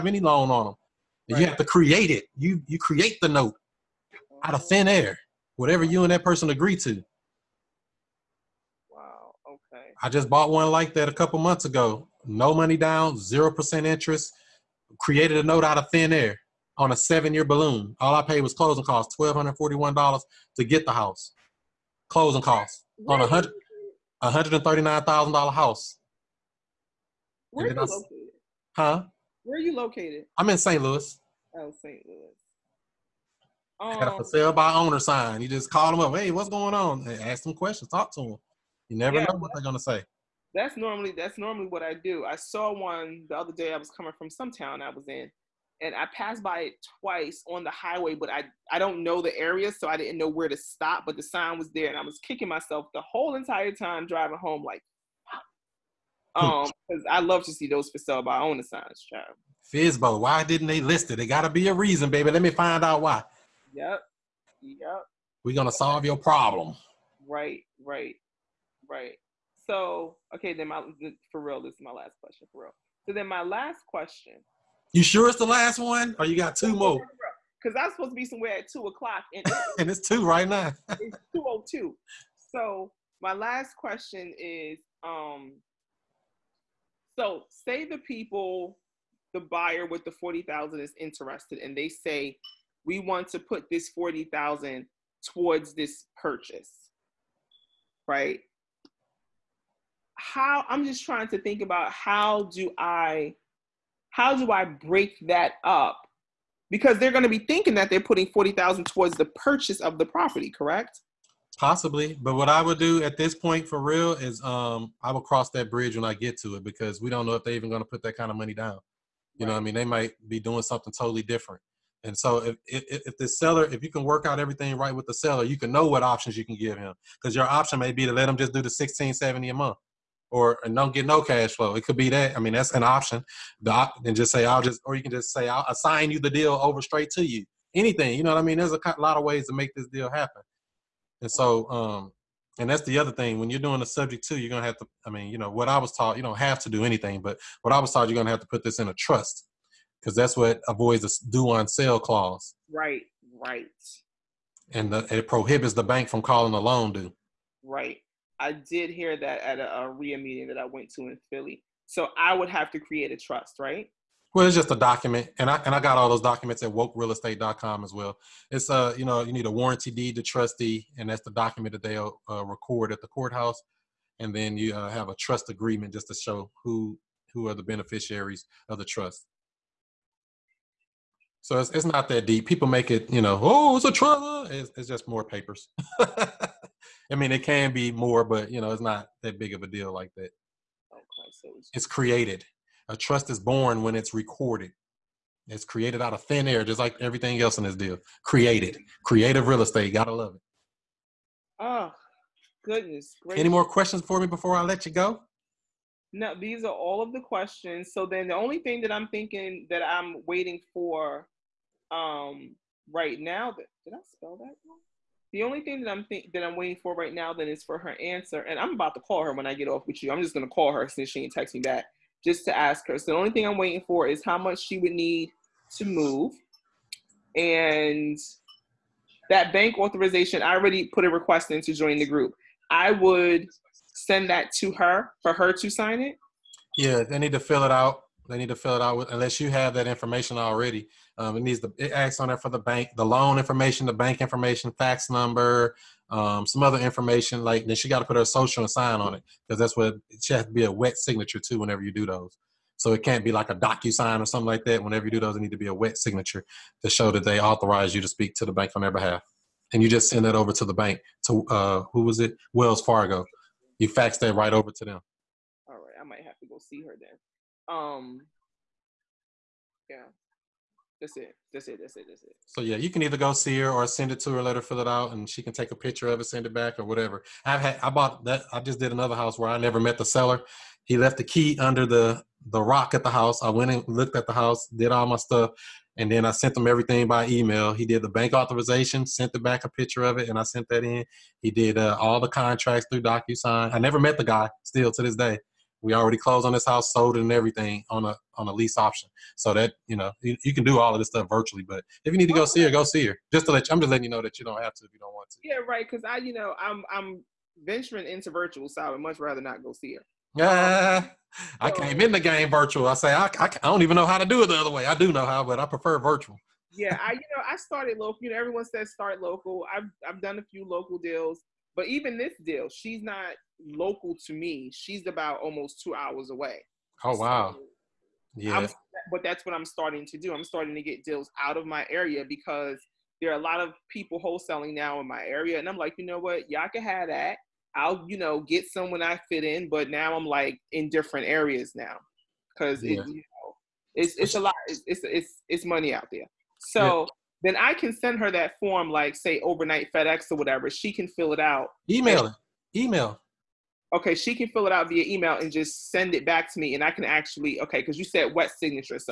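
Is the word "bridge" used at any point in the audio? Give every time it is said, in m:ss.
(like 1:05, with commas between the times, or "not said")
1:55.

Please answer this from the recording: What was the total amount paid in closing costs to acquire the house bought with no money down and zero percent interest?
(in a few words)
$1,241.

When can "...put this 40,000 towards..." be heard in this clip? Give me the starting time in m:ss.
1:33.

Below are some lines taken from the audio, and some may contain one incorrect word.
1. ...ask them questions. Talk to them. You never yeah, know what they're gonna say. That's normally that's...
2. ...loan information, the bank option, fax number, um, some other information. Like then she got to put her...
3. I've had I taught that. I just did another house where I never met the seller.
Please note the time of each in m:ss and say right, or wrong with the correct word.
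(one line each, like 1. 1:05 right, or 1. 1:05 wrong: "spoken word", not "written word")
1. 0:37 right
2. 4:03 wrong: "information", not "option"
3. 4:37 wrong: "bought", not "taught".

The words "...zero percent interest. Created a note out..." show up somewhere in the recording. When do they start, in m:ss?
0:13.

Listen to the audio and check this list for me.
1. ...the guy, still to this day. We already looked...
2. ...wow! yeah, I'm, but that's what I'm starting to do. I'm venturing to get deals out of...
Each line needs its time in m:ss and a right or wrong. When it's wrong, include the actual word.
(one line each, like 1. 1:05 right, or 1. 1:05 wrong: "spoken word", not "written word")
1. 4:54 wrong: "closed", not "looked"
2. 5:27 wrong: "starting", not "venturing".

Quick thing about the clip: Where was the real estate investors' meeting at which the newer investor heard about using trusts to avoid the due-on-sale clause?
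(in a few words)
Philly.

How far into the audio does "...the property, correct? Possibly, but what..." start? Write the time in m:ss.
1:49.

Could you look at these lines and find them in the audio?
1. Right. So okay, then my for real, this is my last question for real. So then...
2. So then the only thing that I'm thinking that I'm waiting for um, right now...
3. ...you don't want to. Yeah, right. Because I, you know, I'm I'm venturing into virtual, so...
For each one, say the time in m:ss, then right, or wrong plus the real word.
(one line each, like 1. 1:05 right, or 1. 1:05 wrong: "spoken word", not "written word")
1. 1:08 right
2. 3:27 right
3. 5:04 right.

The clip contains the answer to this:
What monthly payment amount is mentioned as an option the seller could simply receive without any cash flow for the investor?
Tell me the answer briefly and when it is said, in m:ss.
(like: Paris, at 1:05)
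1670, at 2:08.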